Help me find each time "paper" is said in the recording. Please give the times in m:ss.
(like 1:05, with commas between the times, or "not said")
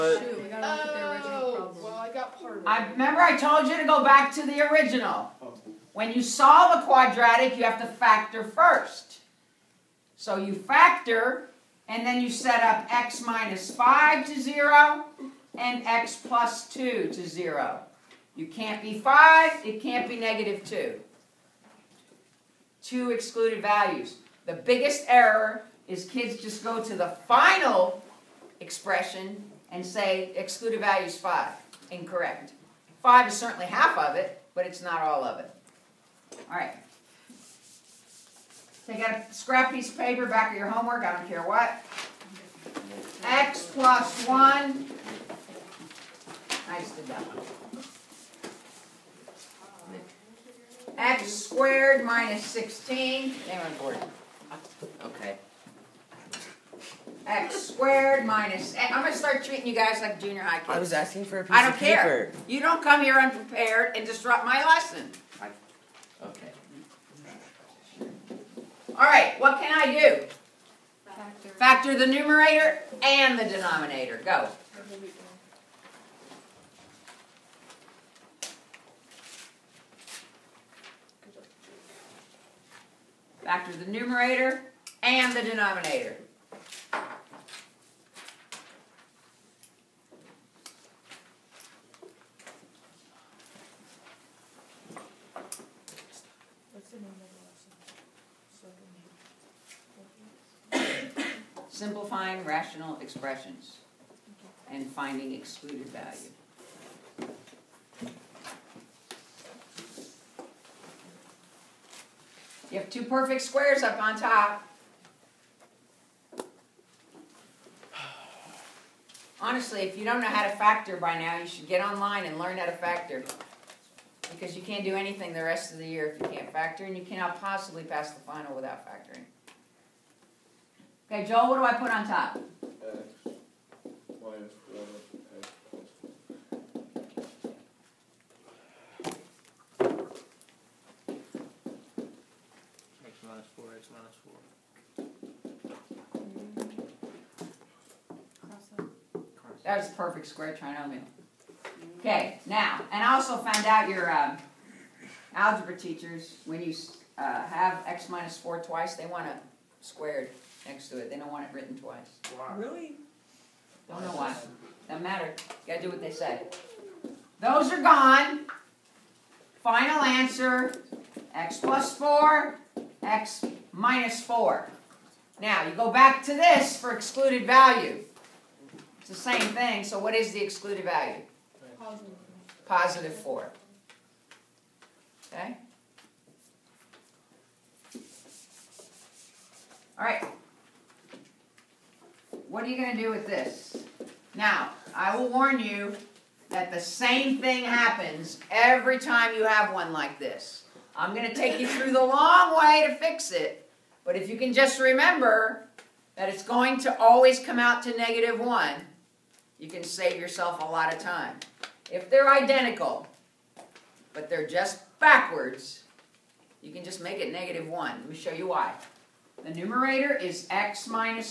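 0:39, 1:01.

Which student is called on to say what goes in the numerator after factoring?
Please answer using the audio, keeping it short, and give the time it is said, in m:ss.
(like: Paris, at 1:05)
Joel, at 2:11.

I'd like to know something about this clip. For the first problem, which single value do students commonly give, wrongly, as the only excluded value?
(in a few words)
5.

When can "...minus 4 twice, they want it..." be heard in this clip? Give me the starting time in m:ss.
2:38.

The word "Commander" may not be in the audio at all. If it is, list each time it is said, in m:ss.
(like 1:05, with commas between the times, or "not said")
not said.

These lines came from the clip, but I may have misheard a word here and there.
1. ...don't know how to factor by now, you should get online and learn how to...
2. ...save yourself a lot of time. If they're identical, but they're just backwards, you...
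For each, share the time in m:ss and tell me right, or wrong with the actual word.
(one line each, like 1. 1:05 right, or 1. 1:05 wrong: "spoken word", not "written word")
1. 2:00 right
2. 3:29 right.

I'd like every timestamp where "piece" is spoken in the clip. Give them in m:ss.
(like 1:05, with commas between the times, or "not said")
0:39, 1:01.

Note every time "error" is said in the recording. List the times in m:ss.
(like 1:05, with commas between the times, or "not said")
0:25.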